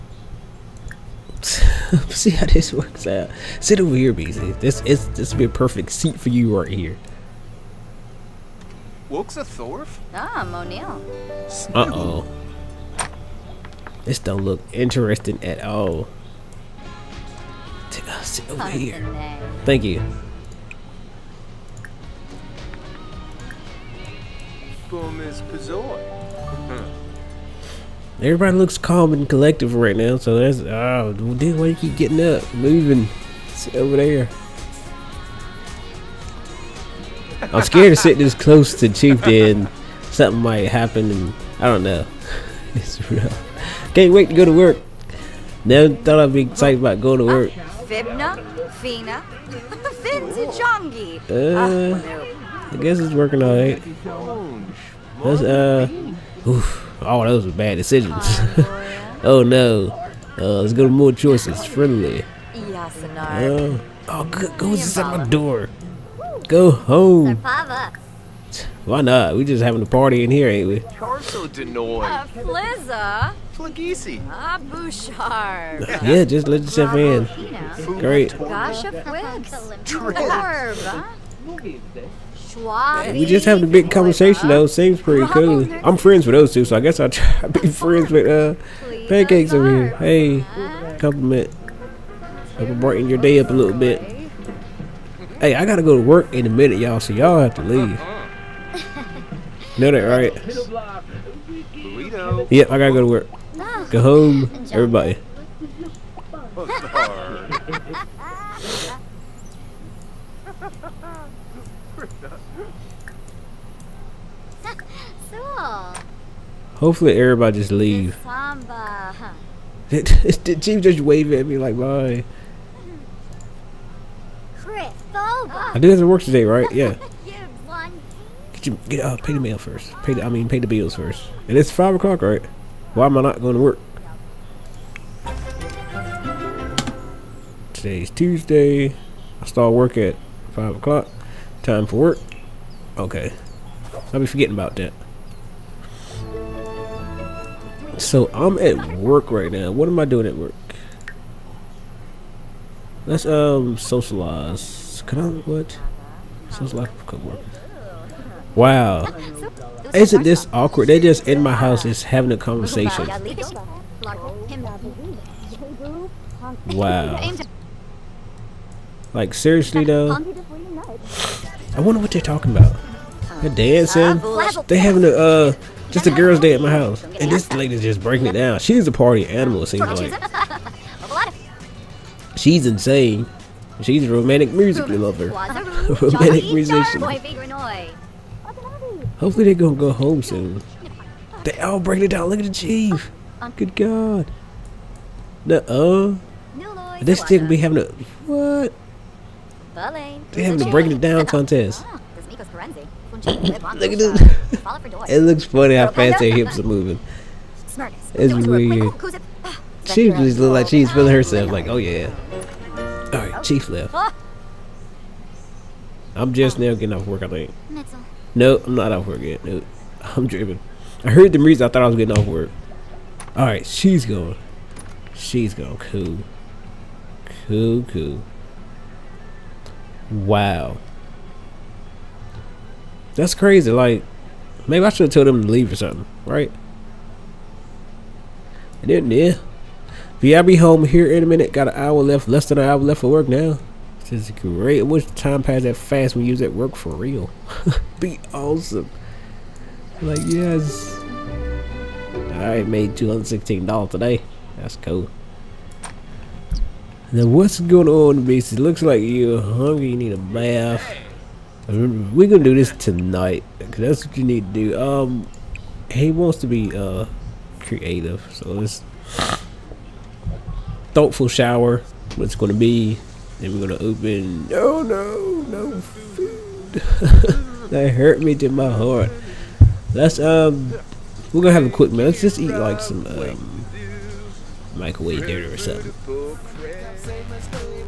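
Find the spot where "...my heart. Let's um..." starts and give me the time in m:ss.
4:38.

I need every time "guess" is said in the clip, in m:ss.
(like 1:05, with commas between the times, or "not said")
0:52, 1:26.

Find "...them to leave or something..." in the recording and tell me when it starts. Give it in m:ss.
3:55.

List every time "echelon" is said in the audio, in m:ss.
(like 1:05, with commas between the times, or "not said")
not said.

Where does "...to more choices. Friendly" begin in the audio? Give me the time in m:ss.
1:00.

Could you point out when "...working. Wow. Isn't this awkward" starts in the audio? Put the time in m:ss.
2:37.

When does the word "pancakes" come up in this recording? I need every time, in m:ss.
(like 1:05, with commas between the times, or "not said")
1:29.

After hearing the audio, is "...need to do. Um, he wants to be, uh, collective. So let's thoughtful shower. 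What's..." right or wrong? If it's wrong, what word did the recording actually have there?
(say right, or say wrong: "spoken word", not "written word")
wrong: "creative", not "collective".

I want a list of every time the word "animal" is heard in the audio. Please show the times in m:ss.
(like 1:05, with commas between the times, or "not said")
2:59.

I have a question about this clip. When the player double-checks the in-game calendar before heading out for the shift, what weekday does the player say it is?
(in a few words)
Tuesday.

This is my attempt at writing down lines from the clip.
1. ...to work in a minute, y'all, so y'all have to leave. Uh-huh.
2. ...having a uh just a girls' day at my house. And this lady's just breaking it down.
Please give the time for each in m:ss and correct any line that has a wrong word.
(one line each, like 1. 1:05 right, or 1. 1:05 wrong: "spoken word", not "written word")
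1. 1:35 right
2. 2:54 right.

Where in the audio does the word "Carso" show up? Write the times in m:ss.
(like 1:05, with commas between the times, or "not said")
1:10.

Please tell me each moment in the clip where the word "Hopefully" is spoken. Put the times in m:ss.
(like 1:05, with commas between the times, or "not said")
1:56, 3:09.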